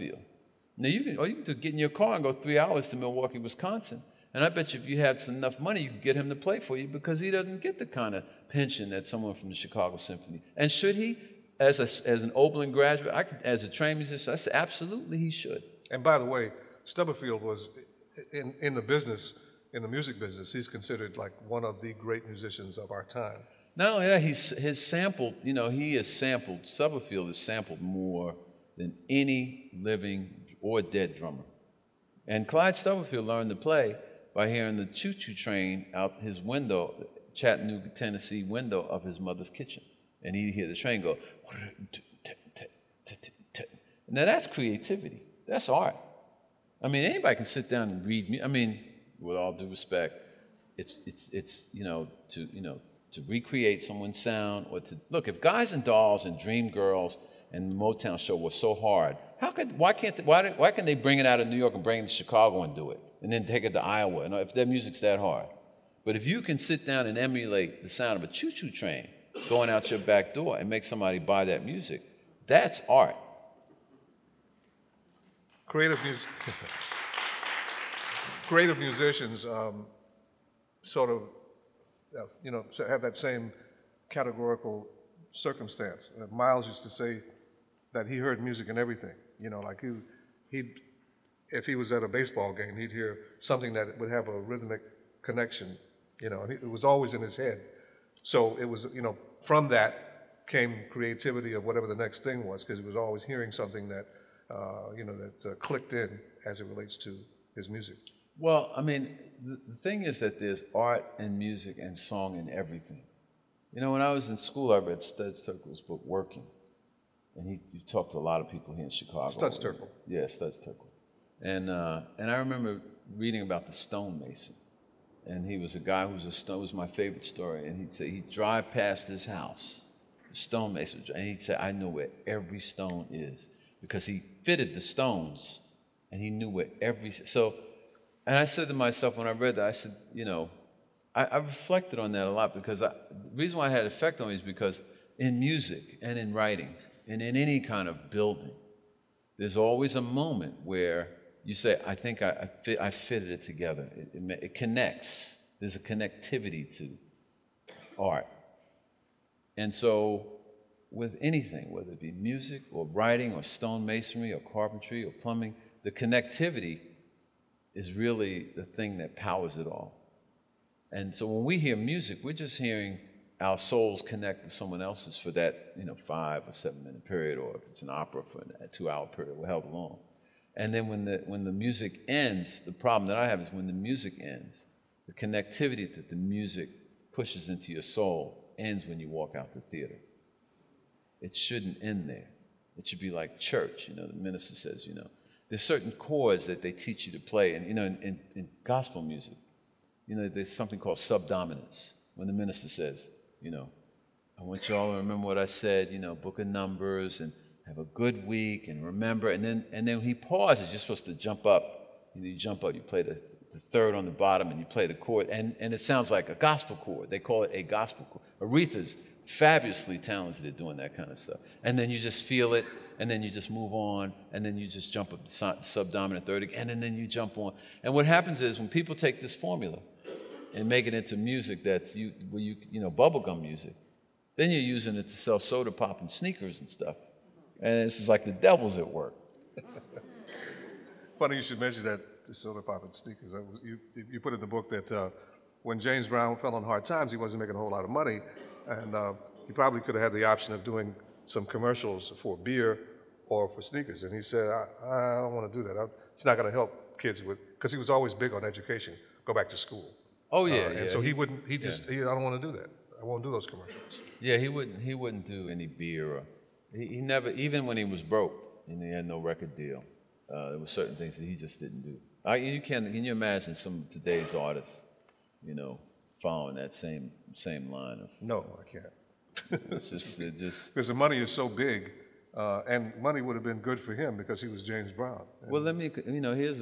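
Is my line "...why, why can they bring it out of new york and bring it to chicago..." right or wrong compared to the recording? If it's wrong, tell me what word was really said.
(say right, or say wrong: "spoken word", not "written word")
right.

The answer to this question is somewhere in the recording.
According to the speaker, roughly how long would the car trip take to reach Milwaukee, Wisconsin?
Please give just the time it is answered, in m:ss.
0:02.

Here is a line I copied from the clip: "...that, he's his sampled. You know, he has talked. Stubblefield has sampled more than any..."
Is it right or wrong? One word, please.
wrong.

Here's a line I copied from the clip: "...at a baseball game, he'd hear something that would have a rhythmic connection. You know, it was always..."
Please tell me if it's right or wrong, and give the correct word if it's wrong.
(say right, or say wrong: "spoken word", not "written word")
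right.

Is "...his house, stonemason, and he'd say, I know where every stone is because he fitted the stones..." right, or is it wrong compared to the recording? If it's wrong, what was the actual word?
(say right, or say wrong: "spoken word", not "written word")
right.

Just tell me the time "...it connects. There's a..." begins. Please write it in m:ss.
2:34.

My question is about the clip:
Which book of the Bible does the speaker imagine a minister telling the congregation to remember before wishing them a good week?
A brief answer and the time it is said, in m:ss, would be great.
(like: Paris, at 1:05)
Book of Numbers, at 3:26.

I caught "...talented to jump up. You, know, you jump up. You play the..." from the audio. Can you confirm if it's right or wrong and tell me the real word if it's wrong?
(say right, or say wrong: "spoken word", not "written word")
wrong: "supposed", not "talented".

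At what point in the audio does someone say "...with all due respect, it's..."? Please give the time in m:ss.
0:49.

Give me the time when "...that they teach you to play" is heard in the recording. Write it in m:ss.
3:16.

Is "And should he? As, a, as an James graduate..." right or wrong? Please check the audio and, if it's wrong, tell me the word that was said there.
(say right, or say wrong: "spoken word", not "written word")
wrong: "Oberlin", not "James".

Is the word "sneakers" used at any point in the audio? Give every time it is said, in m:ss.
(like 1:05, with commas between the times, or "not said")
3:56, 4:02, 4:13.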